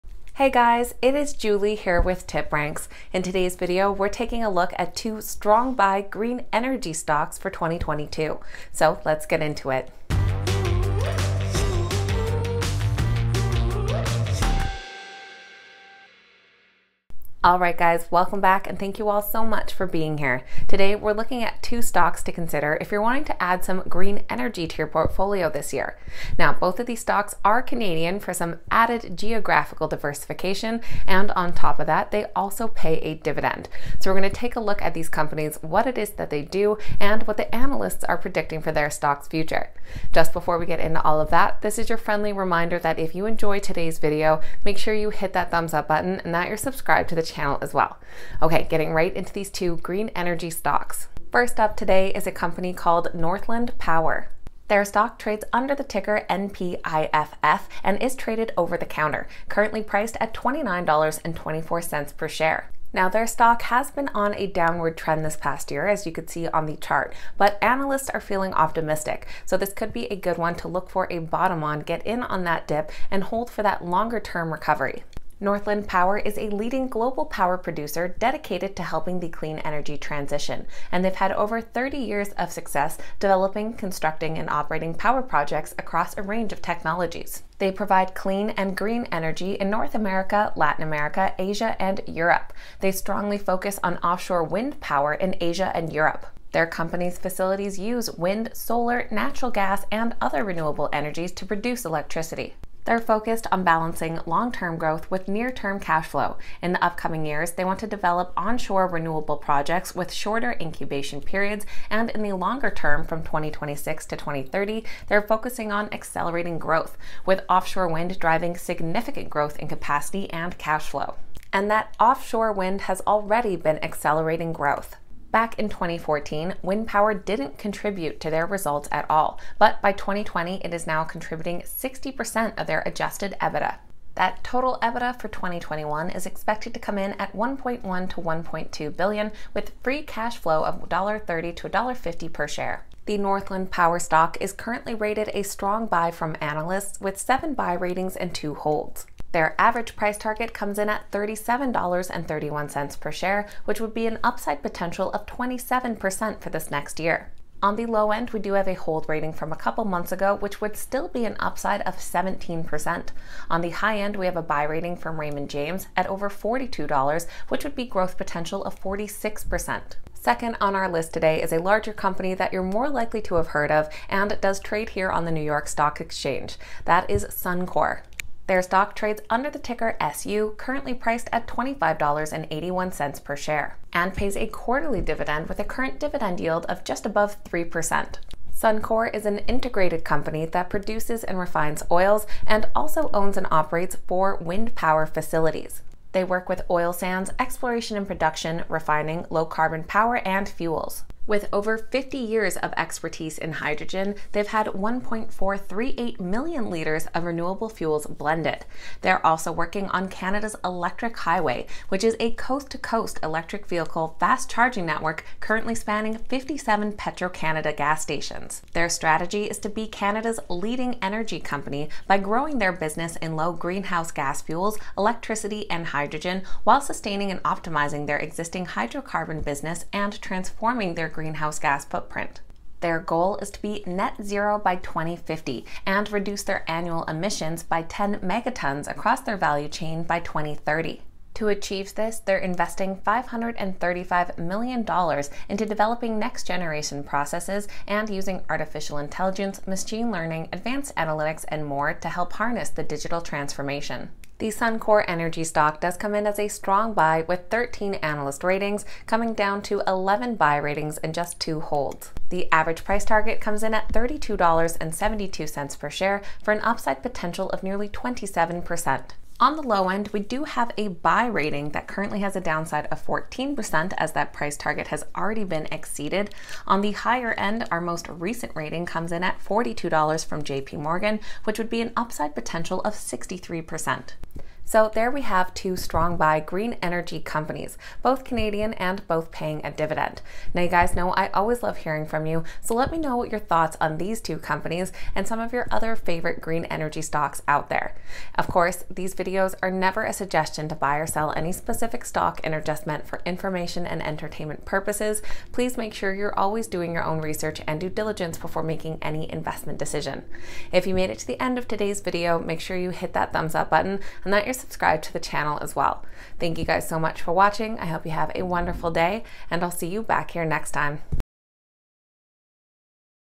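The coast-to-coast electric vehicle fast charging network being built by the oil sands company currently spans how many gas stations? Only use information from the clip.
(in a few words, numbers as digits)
57.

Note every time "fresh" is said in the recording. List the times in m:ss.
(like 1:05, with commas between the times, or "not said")
not said.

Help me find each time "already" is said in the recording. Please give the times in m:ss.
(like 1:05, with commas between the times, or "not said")
2:03, 4:35.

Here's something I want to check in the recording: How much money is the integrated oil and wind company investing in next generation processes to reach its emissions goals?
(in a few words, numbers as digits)
$535 million.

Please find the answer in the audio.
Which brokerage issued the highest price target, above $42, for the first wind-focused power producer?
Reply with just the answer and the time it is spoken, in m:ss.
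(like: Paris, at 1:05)
Raymond James, at 2:45.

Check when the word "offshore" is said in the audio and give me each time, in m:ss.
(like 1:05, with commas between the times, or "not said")
1:33, 1:57, 2:01.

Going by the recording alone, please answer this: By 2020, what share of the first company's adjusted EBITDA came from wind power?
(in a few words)
60%.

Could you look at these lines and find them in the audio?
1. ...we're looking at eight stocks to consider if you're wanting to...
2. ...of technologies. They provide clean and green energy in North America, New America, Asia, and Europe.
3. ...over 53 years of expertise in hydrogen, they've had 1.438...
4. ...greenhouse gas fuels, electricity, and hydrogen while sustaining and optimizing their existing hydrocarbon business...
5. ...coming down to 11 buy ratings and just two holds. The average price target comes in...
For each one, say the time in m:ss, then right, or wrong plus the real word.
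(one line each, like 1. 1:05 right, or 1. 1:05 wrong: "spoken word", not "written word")
1. 0:20 wrong: "two", not "eight"
2. 1:26 wrong: "Latin", not "New"
3. 3:21 wrong: "50", not "53"
4. 3:43 right
5. 4:19 right.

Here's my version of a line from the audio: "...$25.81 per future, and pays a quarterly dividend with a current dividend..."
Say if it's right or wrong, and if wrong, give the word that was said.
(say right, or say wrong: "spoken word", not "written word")
wrong: "share", not "future".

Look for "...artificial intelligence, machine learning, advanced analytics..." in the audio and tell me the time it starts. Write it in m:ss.
4:08.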